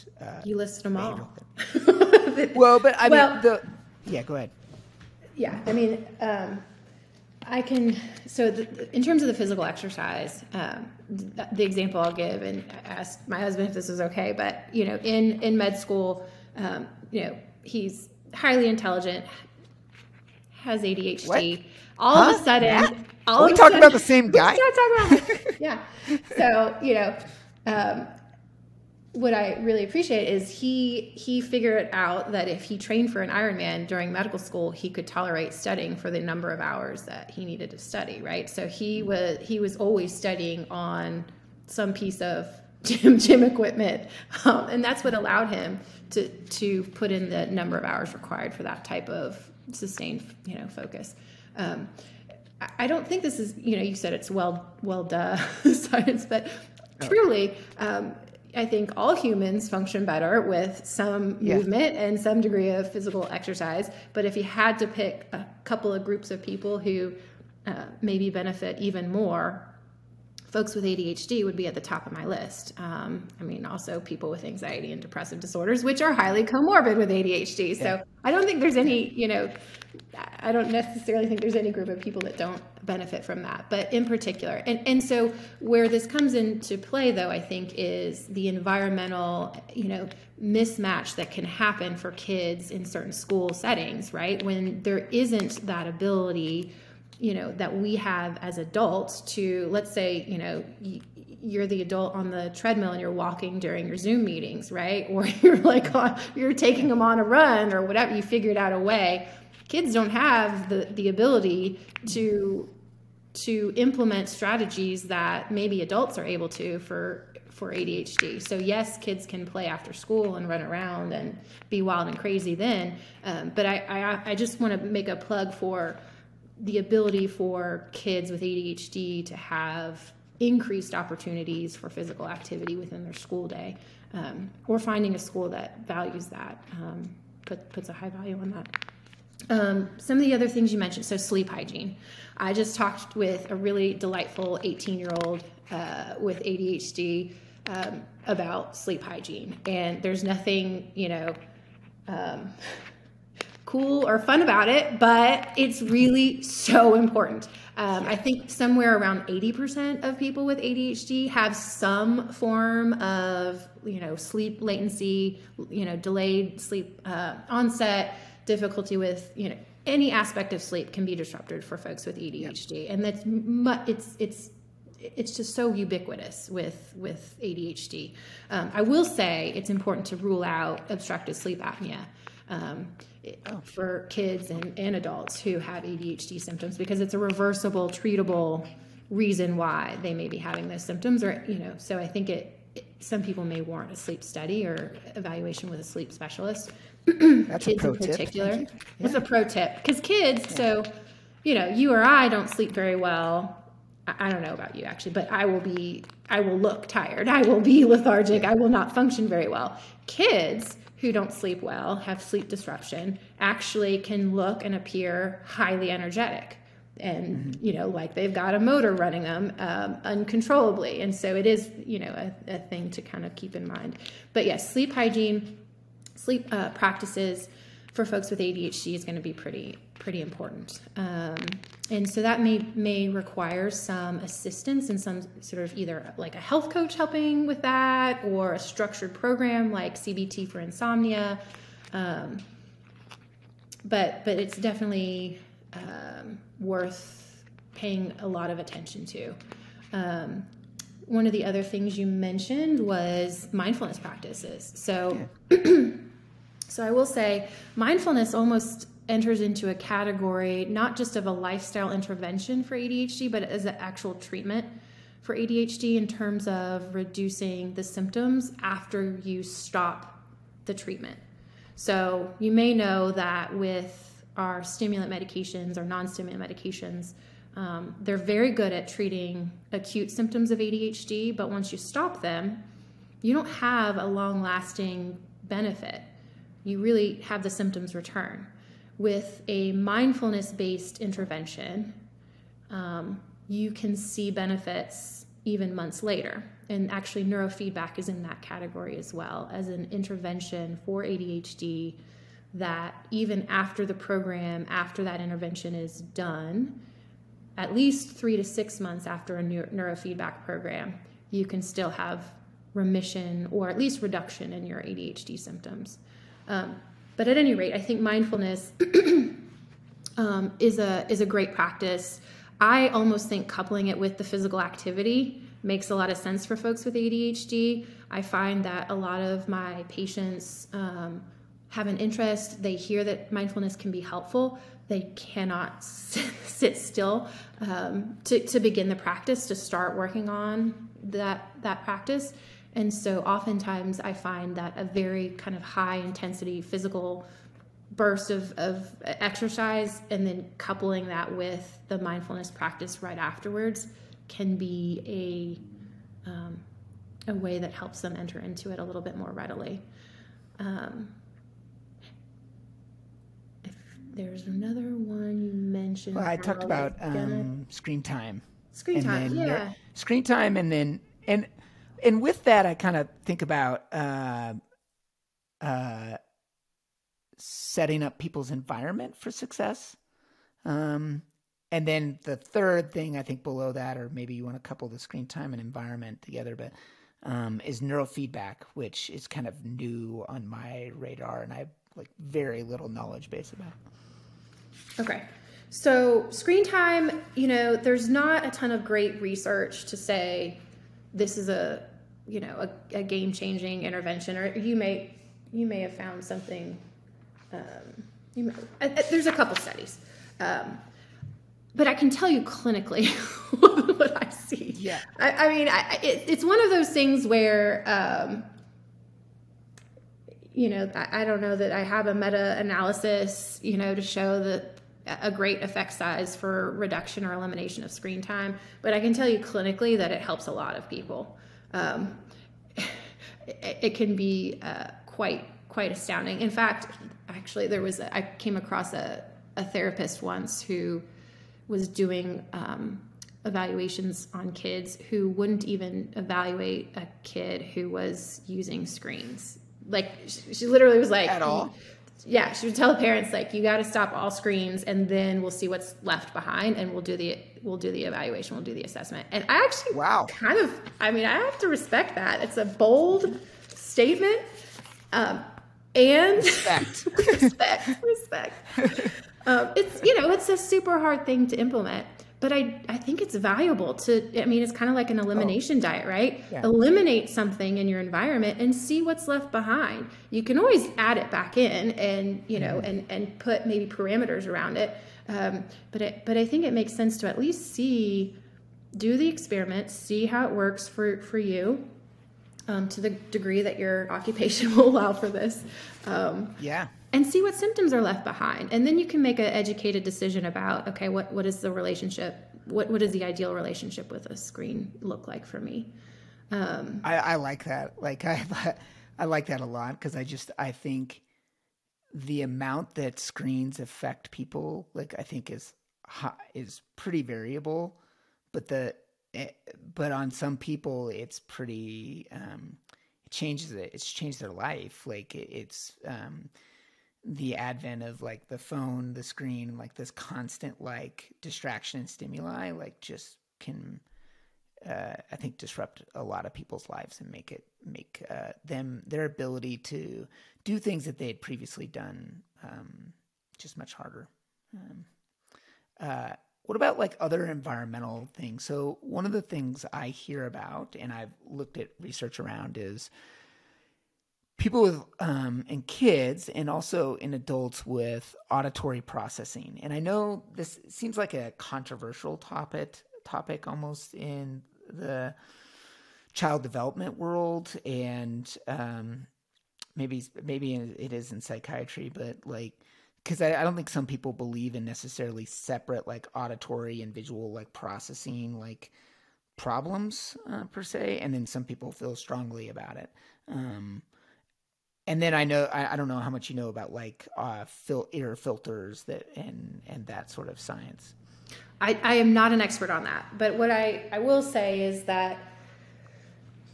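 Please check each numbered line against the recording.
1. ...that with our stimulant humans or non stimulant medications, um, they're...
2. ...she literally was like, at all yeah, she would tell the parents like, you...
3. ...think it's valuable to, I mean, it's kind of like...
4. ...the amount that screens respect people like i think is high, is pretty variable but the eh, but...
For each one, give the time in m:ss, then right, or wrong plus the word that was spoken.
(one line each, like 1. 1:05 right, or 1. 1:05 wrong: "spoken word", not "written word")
1. 4:33 wrong: "medications", not "humans"
2. 7:30 right
3. 7:52 right
4. 8:32 wrong: "affect", not "respect".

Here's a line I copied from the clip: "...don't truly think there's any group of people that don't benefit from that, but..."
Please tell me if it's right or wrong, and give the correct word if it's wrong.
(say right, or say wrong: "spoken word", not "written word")
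wrong: "necessarily", not "truly".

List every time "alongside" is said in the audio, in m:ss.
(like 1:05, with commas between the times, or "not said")
not said.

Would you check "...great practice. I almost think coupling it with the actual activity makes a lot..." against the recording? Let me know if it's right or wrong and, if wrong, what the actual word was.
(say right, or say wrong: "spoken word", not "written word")
wrong: "physical", not "actual".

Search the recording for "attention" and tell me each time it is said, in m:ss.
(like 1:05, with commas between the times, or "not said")
4:08.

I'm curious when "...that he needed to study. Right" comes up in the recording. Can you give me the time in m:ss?
0:37.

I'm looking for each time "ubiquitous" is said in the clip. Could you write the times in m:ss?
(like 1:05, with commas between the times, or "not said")
2:55.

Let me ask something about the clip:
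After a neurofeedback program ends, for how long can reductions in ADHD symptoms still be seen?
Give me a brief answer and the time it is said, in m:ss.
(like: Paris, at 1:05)
3 to 6 months, at 5:08.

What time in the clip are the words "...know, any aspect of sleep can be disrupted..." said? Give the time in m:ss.
2:49.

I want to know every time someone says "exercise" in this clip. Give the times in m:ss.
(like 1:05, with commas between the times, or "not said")
0:09, 1:03, 5:49.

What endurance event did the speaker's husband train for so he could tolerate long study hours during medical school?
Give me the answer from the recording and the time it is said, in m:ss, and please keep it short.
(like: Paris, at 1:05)
Ironman, at 0:33.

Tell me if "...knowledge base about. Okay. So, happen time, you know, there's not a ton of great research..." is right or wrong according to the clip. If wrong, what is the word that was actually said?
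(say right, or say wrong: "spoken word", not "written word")
wrong: "screen", not "happen".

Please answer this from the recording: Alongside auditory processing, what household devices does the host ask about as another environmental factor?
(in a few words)
Air filters.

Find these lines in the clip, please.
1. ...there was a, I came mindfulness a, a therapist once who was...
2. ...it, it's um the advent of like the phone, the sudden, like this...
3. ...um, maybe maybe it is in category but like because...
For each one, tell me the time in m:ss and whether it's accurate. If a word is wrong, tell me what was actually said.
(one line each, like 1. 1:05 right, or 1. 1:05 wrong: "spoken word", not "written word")
1. 7:17 wrong: "across", not "mindfulness"
2. 8:45 wrong: "screen", not "sudden"
3. 9:28 wrong: "psychiatry", not "category".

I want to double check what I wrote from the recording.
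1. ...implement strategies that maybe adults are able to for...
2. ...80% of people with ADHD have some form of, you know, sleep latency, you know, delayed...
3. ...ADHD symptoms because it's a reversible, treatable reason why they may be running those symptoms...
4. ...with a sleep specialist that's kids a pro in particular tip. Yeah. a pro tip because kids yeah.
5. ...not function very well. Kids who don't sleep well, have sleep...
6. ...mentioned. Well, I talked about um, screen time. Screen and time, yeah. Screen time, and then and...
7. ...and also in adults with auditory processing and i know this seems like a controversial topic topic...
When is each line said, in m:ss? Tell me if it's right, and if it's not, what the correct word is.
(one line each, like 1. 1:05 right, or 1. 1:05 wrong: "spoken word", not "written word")
1. 1:53 right
2. 2:39 right
3. 3:05 wrong: "having", not "running"
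4. 3:15 right
5. 3:28 right
6. 6:05 right
7. 9:16 right.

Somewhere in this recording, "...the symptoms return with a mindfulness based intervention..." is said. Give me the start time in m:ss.
4:47.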